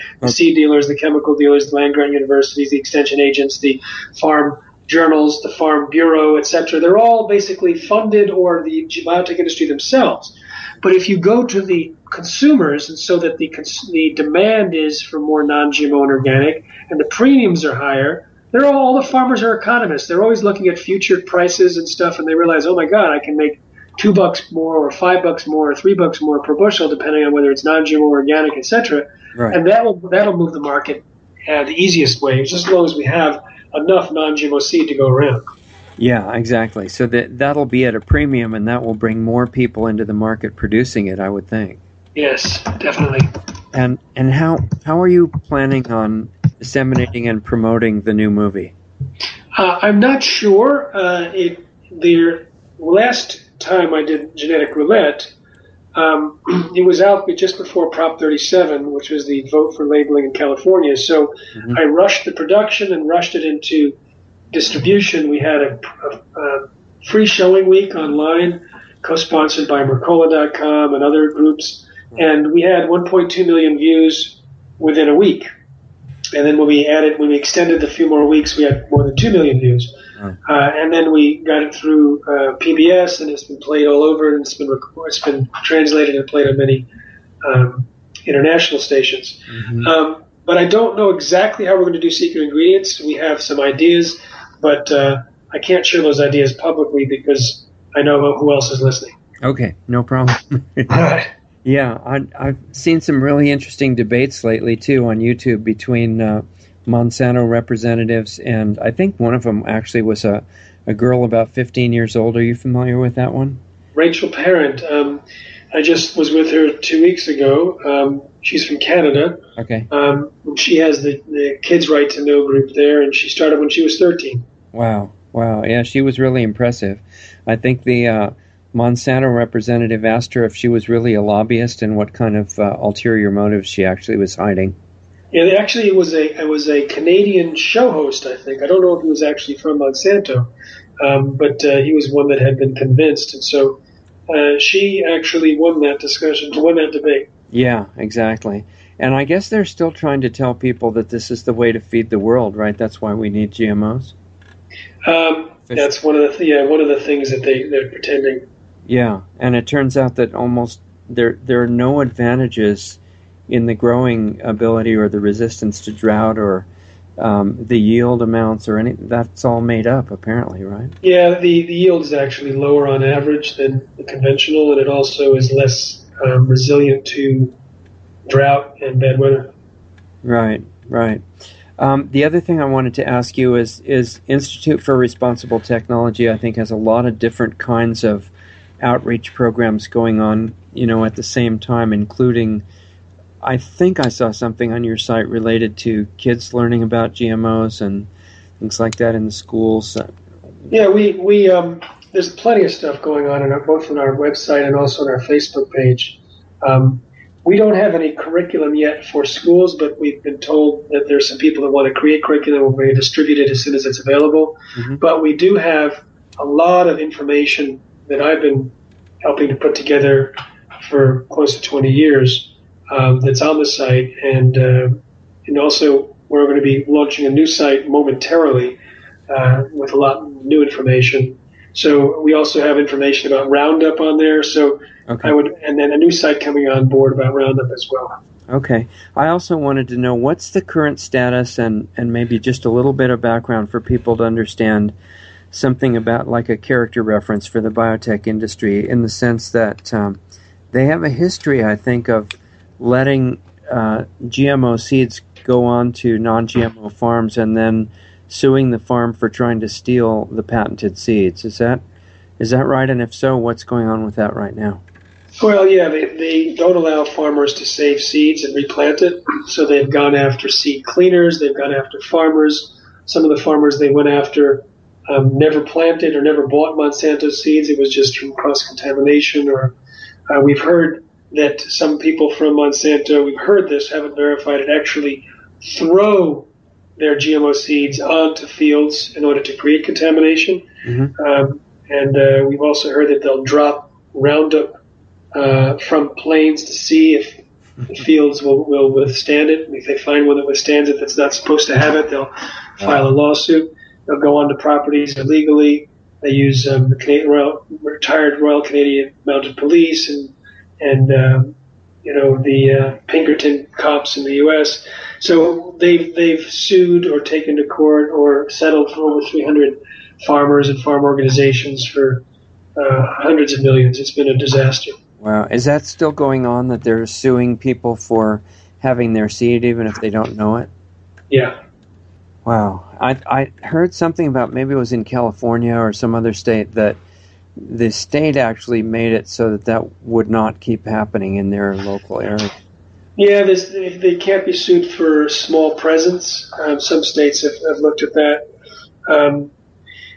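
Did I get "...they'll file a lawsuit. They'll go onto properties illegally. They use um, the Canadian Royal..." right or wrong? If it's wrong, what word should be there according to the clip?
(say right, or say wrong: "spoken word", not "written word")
right.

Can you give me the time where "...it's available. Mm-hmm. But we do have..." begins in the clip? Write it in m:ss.
3:33.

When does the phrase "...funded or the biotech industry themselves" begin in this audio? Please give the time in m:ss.
0:07.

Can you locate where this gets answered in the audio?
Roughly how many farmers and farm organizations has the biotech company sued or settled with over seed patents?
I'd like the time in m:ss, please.
5:19.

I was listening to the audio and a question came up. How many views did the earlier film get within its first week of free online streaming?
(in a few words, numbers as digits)
1.2 million.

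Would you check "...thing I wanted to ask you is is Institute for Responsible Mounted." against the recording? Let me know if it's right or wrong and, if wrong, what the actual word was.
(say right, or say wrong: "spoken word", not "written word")
wrong: "Technology", not "Mounted".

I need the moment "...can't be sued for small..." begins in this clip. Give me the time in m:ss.
5:44.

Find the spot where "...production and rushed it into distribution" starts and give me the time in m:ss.
1:02.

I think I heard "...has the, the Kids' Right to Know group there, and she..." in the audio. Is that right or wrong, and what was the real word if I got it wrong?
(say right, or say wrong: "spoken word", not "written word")
right.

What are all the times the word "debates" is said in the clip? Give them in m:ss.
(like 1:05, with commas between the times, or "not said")
1:43, 2:26.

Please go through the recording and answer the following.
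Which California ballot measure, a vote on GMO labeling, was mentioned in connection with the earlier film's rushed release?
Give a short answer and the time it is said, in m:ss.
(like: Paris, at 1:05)
Prop 37, at 0:57.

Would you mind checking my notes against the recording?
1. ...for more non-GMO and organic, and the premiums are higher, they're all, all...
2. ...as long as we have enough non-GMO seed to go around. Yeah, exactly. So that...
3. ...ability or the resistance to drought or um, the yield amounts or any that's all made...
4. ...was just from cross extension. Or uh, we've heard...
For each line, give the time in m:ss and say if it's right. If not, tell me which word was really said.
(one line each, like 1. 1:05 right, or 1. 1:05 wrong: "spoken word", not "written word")
1. 0:15 right
2. 0:32 right
3. 2:44 right
4. 4:37 wrong: "contamination", not "extension".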